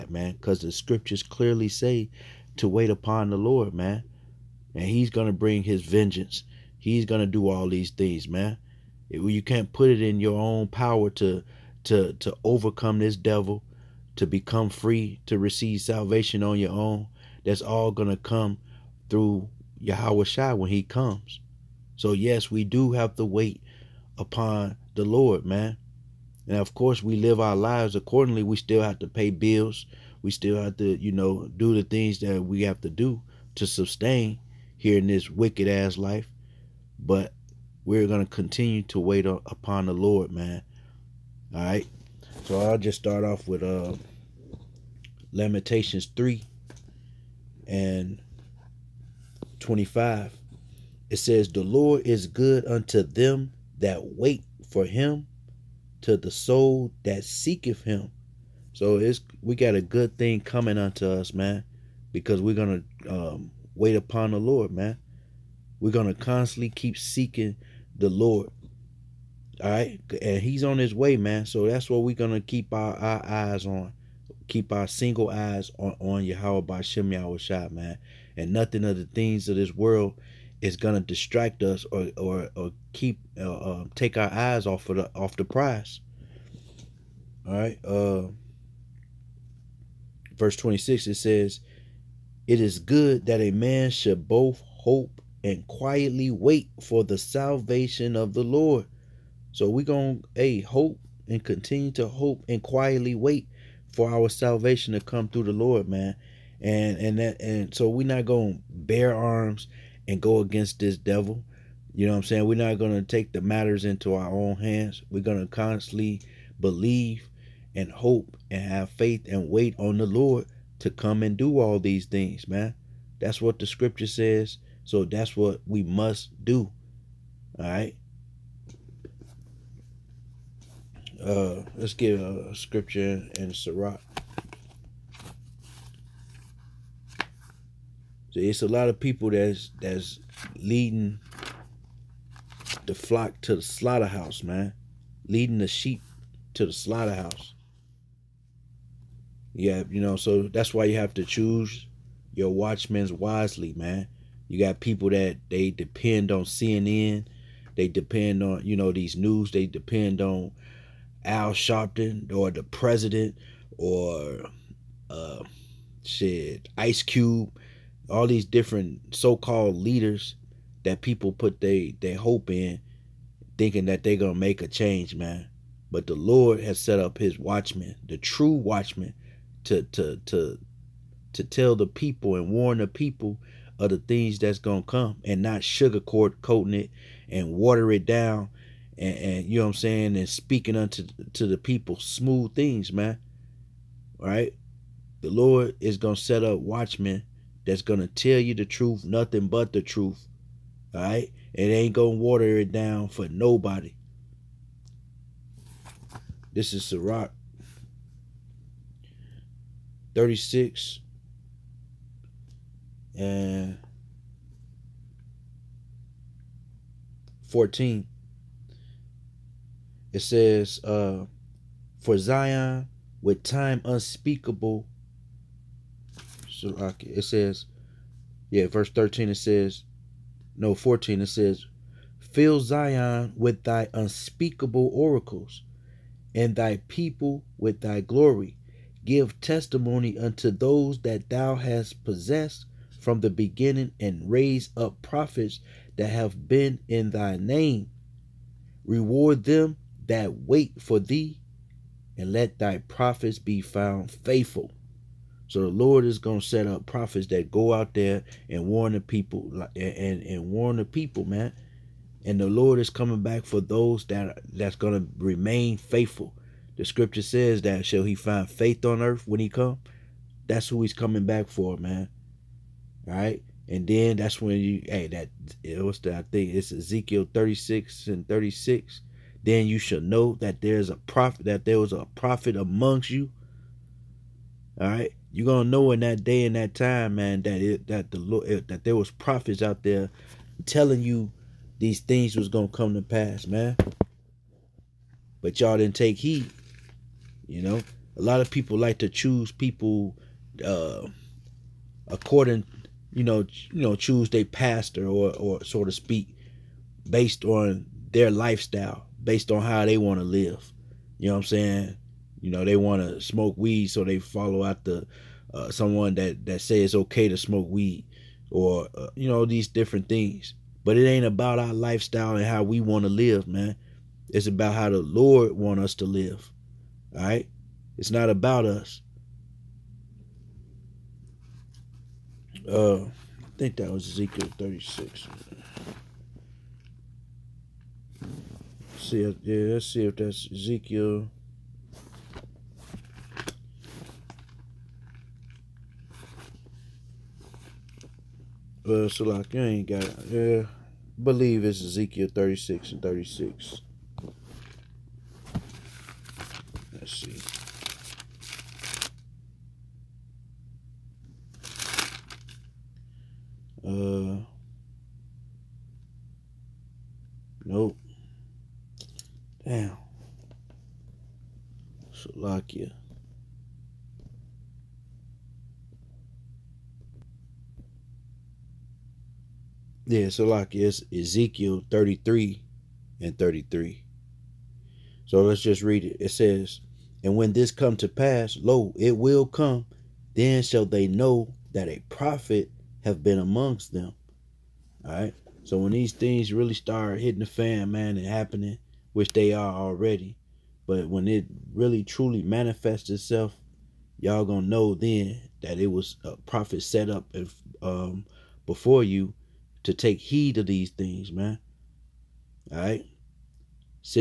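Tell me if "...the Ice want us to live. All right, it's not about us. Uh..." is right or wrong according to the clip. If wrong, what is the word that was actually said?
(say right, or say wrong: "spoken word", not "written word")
wrong: "Lord", not "Ice".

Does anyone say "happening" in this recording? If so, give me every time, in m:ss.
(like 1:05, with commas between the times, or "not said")
6:38.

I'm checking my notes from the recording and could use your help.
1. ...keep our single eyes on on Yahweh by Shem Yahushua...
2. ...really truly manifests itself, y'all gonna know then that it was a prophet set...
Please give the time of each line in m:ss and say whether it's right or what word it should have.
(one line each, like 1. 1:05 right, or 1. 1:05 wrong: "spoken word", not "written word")
1. 1:14 right
2. 6:41 right.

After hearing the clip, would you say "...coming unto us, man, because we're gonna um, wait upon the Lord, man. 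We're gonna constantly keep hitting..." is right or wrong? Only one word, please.
wrong.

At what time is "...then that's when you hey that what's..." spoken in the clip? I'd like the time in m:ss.
4:33.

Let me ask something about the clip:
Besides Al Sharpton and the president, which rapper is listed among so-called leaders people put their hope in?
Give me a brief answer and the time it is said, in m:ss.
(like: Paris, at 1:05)
Ice Cube, at 2:46.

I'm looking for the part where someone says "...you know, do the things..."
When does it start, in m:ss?
0:30.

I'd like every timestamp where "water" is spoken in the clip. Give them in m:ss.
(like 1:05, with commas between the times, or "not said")
3:07, 3:22.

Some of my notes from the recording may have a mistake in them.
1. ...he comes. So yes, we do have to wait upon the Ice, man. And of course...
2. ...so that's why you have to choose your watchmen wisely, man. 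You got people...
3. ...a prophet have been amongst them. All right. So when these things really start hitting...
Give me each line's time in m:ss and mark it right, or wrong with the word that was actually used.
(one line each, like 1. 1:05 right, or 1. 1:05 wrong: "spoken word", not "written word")
1. 0:20 wrong: "Lord", not "Ice"
2. 2:30 right
3. 6:31 right.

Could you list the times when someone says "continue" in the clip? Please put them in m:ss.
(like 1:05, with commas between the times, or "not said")
0:38, 1:41.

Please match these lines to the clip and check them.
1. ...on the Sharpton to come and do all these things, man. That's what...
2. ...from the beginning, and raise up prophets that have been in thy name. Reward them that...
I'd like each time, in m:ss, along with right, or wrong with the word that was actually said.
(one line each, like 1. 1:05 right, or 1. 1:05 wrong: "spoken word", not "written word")
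1. 1:59 wrong: "Lord", not "Sharpton"
2. 4:02 right.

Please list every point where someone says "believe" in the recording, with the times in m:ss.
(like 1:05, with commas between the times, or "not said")
1:56, 5:51.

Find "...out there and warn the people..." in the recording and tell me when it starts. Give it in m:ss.
4:17.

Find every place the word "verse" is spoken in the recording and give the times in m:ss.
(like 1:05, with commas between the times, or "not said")
1:30, 3:48.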